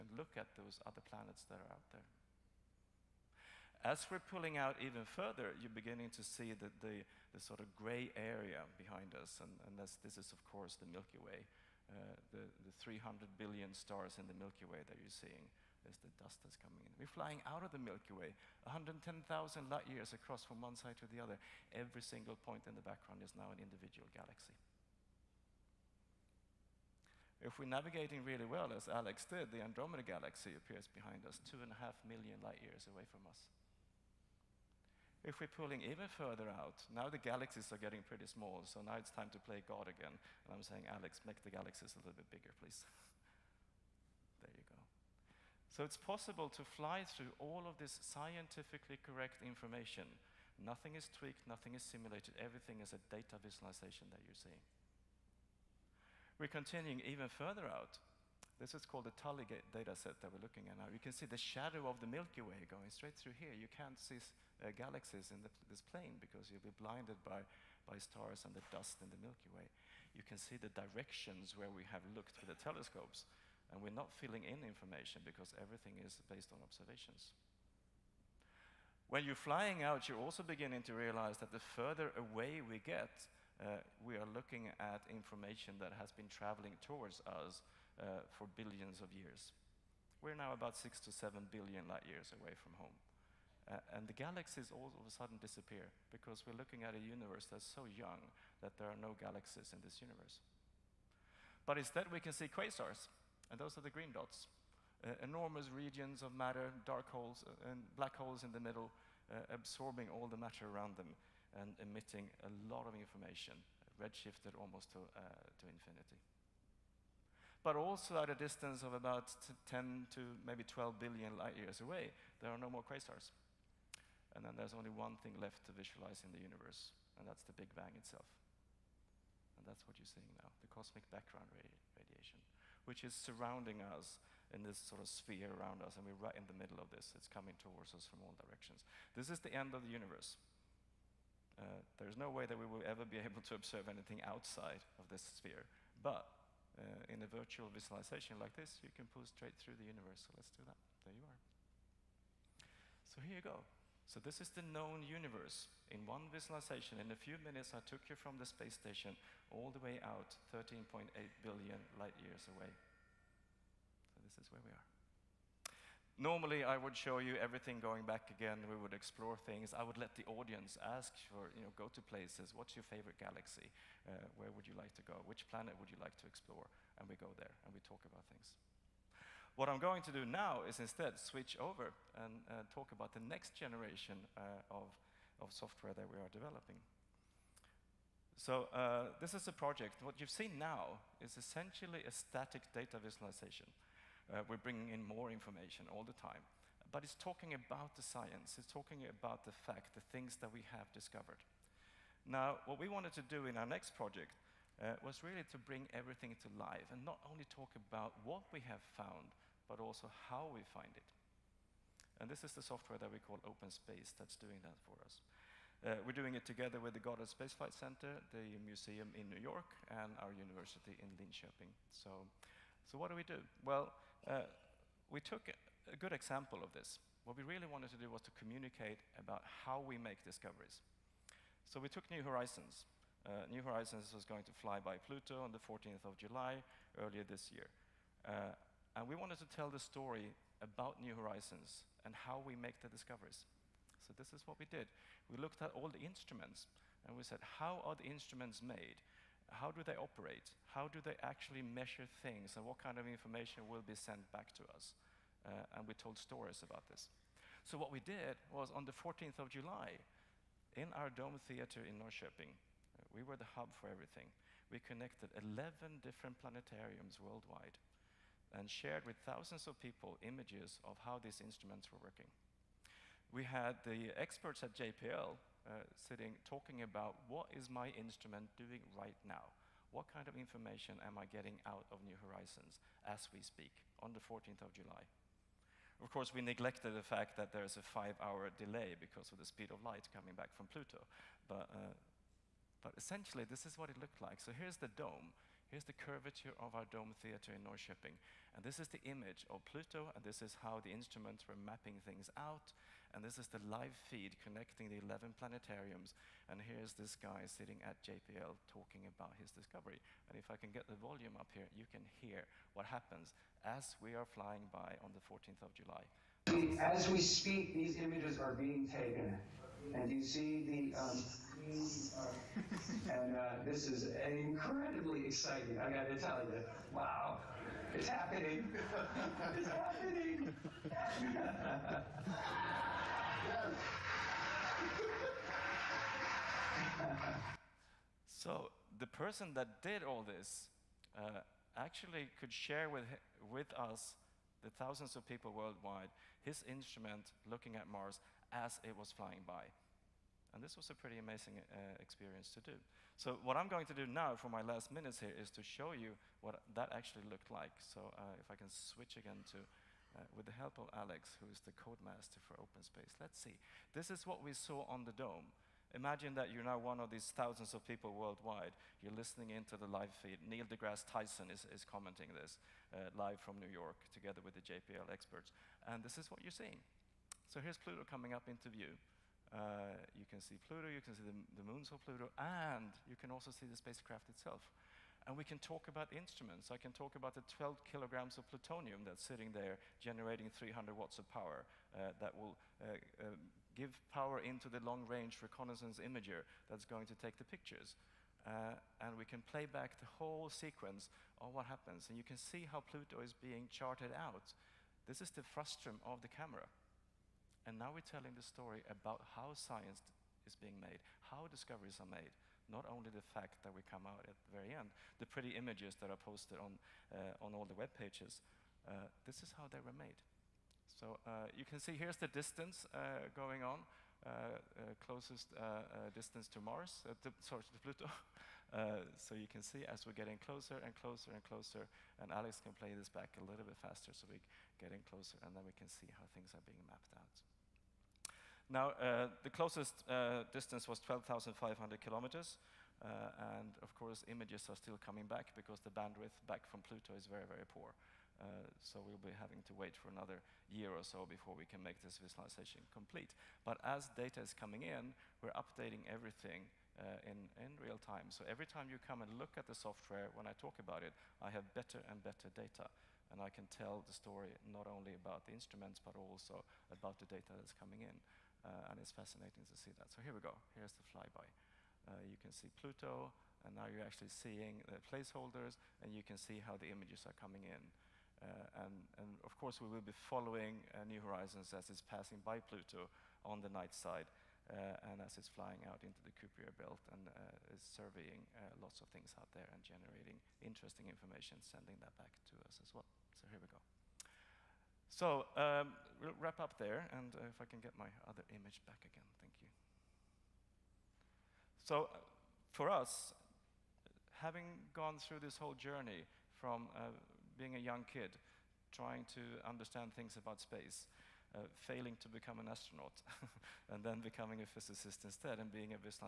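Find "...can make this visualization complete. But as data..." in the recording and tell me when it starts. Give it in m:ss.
7:31.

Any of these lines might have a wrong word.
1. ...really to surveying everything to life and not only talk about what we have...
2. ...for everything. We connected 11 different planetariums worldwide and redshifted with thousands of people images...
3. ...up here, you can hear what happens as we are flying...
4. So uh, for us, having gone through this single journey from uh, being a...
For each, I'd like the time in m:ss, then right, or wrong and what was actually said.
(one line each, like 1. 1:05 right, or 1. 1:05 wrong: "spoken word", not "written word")
1. 3:25 wrong: "bring", not "surveying"
2. 4:23 wrong: "shared", not "redshifted"
3. 5:11 right
4. 8:21 wrong: "whole", not "single".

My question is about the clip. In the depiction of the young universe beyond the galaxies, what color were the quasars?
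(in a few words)
Green.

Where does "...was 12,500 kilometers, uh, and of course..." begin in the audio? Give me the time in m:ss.
7:20.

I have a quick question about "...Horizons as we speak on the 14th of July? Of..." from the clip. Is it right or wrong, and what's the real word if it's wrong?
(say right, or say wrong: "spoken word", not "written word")
right.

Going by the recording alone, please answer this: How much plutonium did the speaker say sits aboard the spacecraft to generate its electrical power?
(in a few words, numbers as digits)
12 kilograms.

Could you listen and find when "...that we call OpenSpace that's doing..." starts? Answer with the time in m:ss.
3:32.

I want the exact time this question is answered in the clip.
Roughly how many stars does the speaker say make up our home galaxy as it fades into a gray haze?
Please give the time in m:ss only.
0:12.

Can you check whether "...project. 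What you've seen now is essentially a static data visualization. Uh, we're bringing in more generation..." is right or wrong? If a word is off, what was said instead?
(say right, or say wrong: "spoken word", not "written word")
wrong: "information", not "generation".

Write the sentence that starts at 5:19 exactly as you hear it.
And you see the, um, and uh, this is incredibly exciting.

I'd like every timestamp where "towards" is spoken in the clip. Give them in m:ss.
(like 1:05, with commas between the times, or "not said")
1:26, 2:17.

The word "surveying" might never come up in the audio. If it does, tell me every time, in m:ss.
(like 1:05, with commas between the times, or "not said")
8:07.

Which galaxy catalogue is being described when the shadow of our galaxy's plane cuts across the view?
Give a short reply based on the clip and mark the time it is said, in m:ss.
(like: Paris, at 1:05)
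Tully data set, at 0:59.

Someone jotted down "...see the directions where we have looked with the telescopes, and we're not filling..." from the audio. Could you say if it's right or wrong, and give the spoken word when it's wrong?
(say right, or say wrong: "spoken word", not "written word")
right.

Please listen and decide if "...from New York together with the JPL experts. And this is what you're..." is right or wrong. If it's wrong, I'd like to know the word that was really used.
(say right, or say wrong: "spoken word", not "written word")
right.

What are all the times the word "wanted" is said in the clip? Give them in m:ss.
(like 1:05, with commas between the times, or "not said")
3:22, 3:47, 3:59.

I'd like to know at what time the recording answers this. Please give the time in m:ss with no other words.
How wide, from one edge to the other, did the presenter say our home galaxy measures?
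0:18.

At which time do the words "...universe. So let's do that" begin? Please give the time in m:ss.
2:29.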